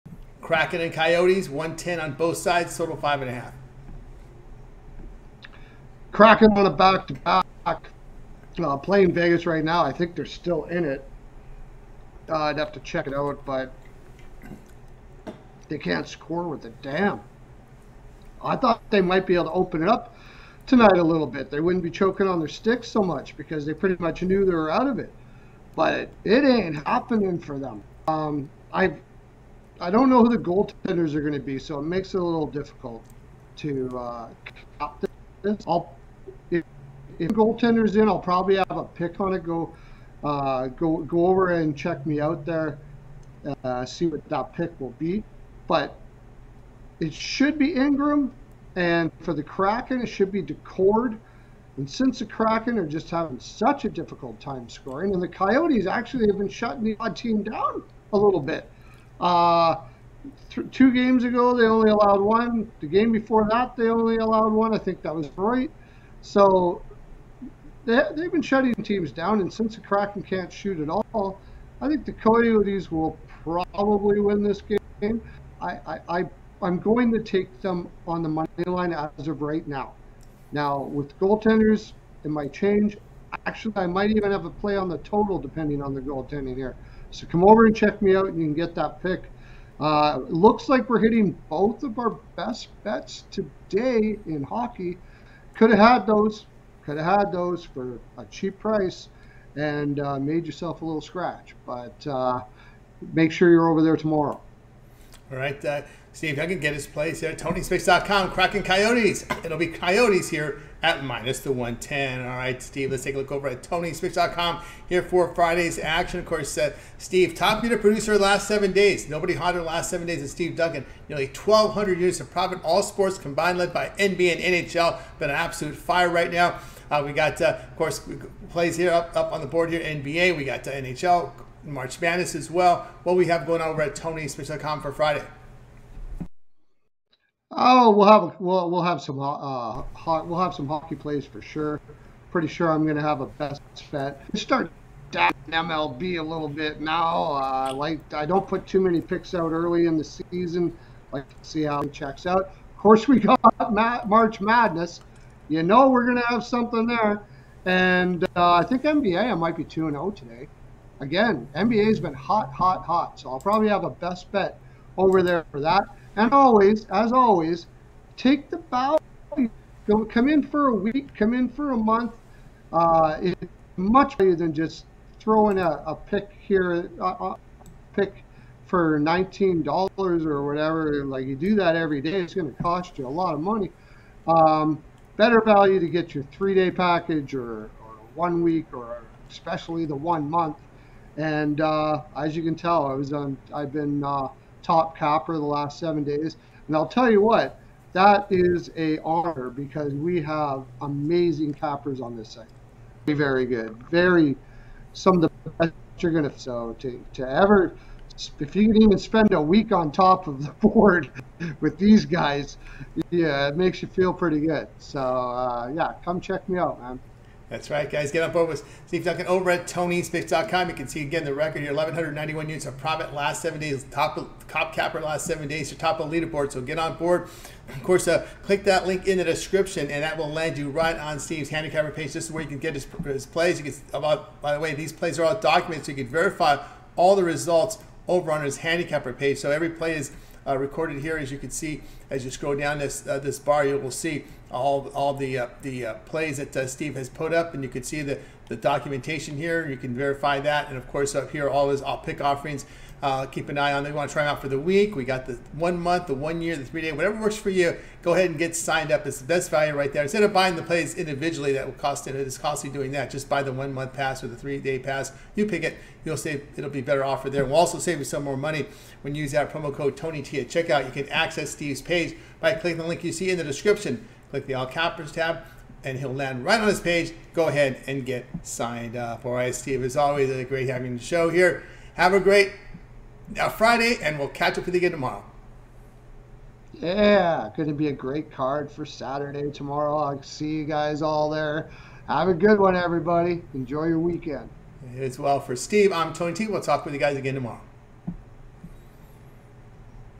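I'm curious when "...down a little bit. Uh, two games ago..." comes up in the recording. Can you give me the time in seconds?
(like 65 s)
57 s.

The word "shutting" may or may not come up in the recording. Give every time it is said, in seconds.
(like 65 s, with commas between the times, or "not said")
56 s, 68 s.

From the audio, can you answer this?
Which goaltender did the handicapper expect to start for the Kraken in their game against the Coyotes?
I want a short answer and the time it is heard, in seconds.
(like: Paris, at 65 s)
Daccord, at 50 s.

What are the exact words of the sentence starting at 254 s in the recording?
We got the one month, the one year, the three day, whatever works for you.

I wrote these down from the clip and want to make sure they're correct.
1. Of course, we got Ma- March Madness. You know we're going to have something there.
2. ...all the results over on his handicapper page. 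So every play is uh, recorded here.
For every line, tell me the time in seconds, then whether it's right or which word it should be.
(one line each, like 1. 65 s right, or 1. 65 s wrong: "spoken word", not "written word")
1. 152 s right
2. 236 s right.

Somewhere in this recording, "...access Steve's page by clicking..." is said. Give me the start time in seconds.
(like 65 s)
271 s.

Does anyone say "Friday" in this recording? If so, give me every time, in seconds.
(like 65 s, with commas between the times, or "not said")
115 s, 134 s, 283 s.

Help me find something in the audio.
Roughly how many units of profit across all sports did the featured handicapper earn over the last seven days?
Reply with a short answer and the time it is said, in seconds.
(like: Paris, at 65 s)
1,200, at 121 s.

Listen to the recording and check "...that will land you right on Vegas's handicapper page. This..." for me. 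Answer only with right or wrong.
wrong.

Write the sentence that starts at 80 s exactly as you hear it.
Now, with goaltenders, it might change.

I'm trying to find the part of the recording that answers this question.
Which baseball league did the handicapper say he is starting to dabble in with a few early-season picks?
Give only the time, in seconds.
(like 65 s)
145 s.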